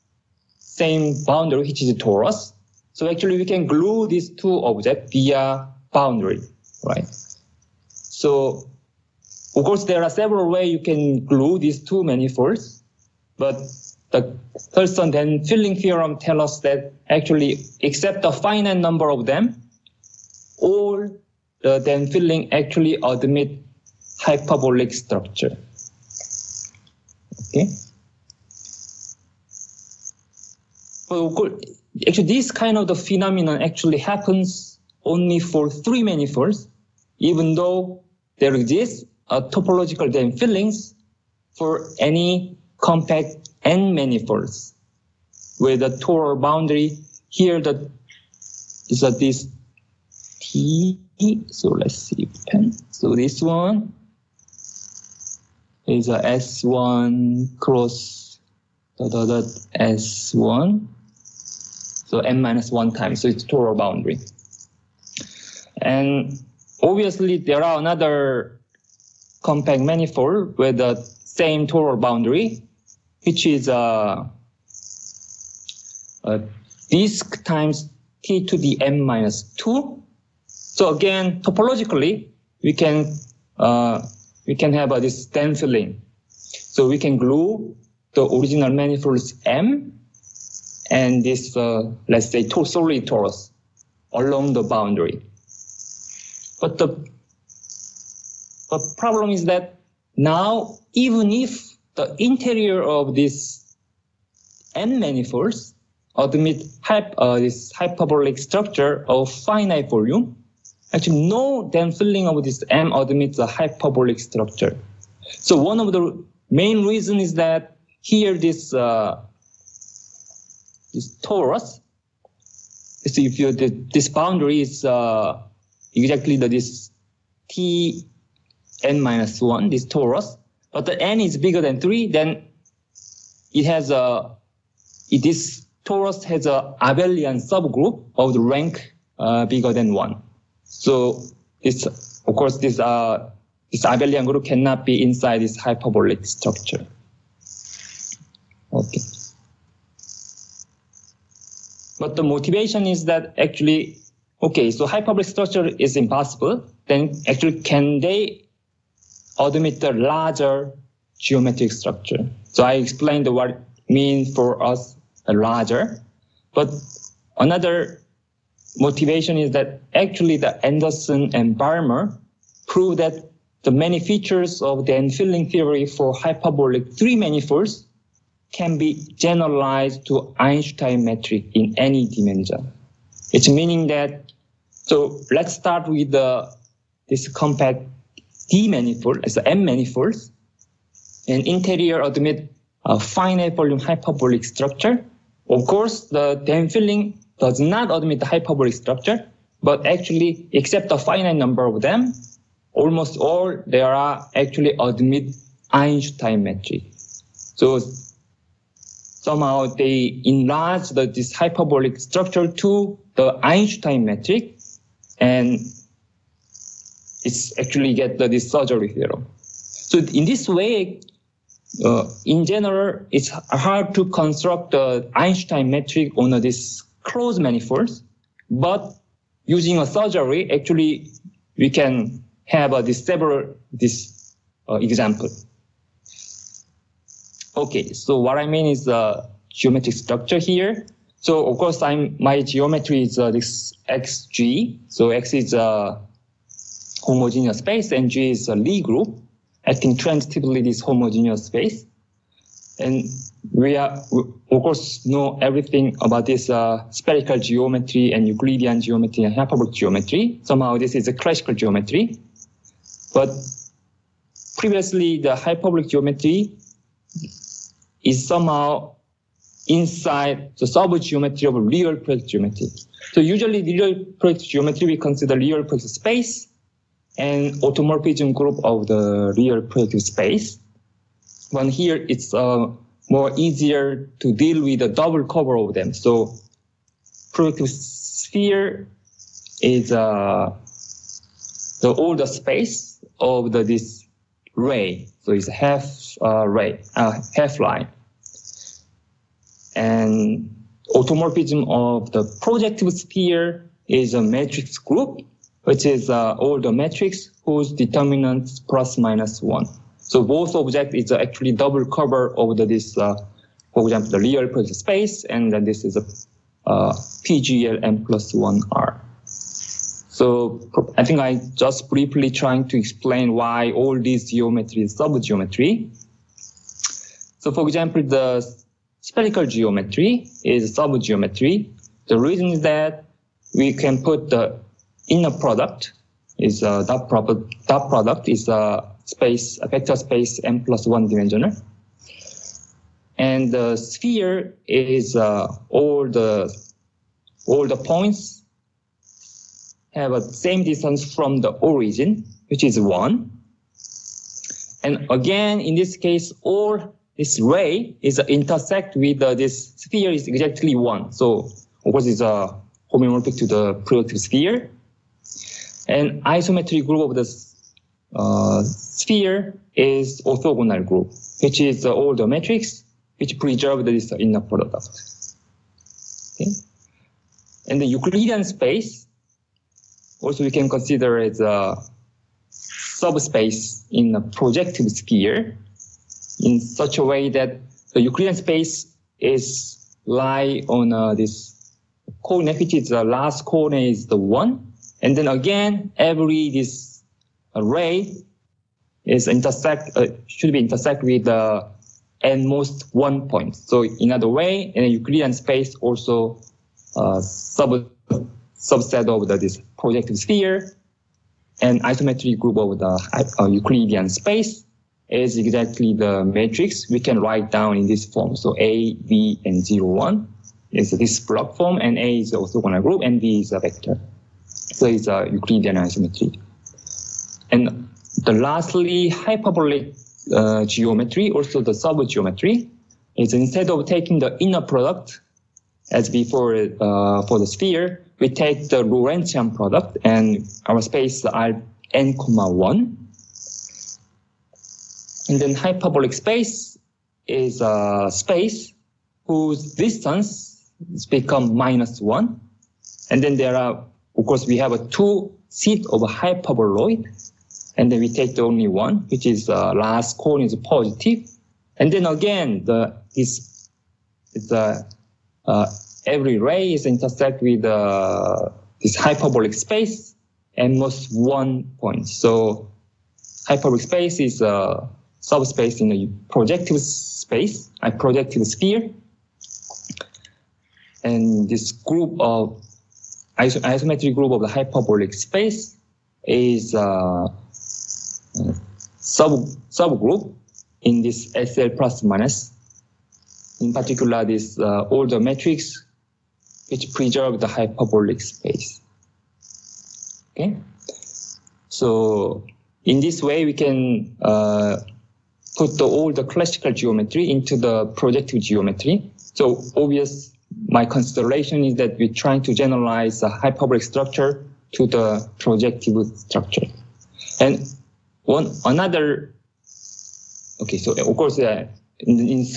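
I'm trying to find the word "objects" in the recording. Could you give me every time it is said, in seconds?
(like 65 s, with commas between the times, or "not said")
4 s, 310 s.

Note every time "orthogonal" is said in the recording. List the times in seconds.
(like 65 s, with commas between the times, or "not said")
370 s, 422 s.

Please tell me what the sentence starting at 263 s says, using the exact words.
But previously, the hyperbolic geometry is somehow inside the subgeometry of real project geometry.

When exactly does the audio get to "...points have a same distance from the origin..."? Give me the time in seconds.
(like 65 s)
347 s.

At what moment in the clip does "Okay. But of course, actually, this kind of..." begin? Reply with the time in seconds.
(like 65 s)
27 s.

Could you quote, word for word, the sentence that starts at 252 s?
And we are, we of course, know everything about this uh, spherical geometry and Euclidean geometry and hyperbolic geometry.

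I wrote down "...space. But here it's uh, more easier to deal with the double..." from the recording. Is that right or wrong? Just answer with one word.
right.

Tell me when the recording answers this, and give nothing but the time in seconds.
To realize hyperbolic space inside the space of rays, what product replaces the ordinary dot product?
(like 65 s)
438 s.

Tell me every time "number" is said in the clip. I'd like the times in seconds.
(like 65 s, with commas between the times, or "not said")
18 s, 201 s.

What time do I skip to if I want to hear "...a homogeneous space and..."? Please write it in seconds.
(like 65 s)
245 s.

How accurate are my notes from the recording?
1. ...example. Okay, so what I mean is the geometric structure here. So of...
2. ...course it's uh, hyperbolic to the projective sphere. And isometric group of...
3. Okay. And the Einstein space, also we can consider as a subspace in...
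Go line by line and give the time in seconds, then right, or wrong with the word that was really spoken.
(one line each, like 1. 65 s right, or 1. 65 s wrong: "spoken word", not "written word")
1. 234 s right
2. 361 s wrong: "homeomorphic", not "hyperbolic"
3. 376 s wrong: "Euclidean", not "Einstein".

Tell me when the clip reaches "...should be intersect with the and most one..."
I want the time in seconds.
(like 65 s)
400 s.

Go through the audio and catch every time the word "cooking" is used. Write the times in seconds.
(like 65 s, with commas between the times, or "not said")
not said.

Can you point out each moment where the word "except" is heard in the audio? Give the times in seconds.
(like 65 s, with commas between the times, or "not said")
17 s, 200 s.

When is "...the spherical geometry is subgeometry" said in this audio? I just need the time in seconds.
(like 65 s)
328 s.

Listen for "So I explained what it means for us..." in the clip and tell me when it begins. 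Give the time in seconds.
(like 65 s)
162 s.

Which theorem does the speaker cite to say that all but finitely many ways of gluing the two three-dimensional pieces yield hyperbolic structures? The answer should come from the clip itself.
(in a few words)
Thurston Dehn filling theorem.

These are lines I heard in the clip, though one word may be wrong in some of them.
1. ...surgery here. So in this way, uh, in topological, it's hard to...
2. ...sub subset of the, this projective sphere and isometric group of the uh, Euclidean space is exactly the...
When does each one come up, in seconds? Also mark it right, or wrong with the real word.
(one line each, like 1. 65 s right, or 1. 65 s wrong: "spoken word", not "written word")
1. 218 s wrong: "general", not "topological"
2. 407 s right.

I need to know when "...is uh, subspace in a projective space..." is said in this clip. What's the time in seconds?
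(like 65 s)
474 s.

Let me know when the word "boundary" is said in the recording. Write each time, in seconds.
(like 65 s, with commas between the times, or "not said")
1 s, 5 s, 46 s, 63 s, 71 s, 94 s, 124 s.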